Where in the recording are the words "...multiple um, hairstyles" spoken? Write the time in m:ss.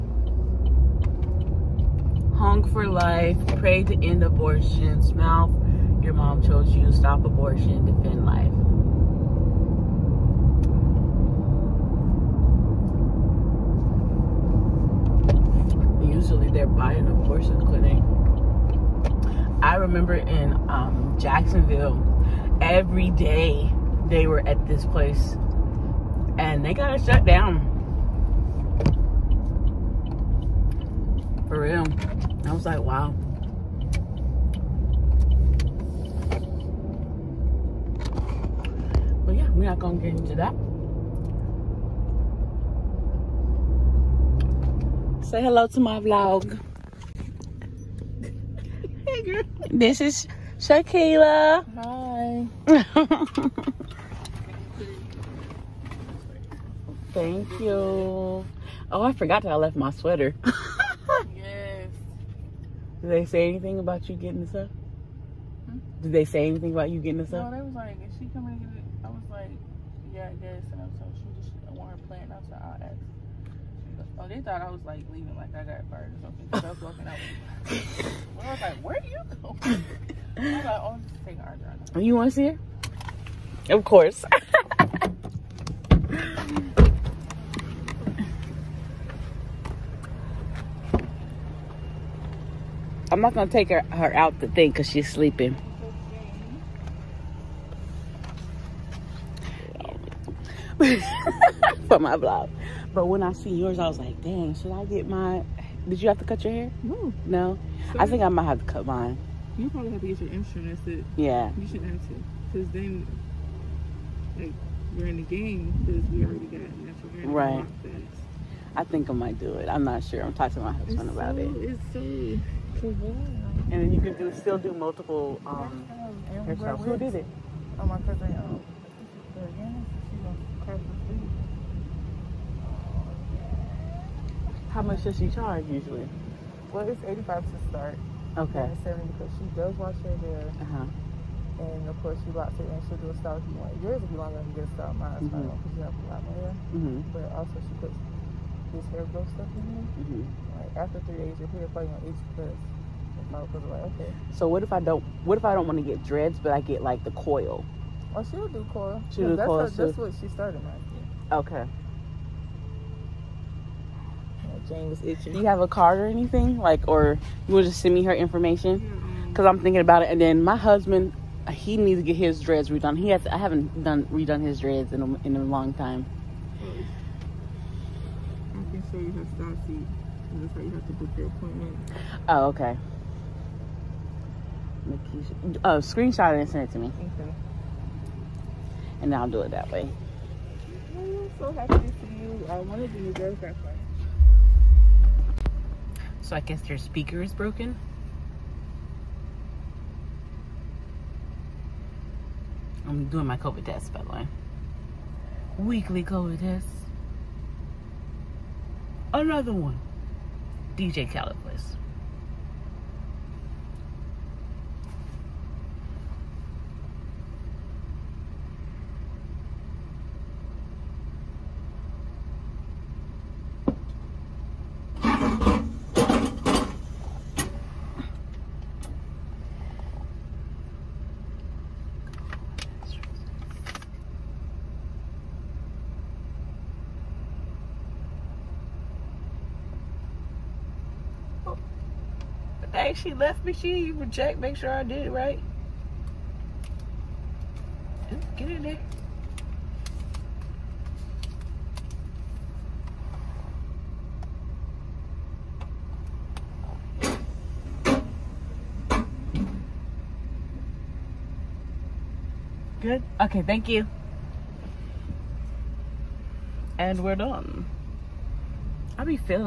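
2:04.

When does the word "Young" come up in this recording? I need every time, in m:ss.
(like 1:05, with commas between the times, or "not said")
0:02.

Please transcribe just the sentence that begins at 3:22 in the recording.
I'm doing my COVID test, by the way.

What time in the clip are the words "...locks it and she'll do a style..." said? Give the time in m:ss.
2:22.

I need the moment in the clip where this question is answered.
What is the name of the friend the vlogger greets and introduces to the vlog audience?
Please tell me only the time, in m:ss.
0:50.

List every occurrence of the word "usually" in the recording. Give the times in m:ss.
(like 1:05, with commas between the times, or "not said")
0:16, 2:15.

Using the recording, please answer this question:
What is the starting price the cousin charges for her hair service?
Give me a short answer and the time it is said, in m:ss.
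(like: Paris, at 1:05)
$85, at 2:17.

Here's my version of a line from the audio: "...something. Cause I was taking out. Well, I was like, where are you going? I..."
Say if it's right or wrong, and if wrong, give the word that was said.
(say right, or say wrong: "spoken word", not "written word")
wrong: "walking", not "taking".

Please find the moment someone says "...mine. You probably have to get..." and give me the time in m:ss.
1:48.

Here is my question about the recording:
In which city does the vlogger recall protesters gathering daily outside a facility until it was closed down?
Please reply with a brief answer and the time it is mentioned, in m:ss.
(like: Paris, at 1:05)
Jacksonville, at 0:21.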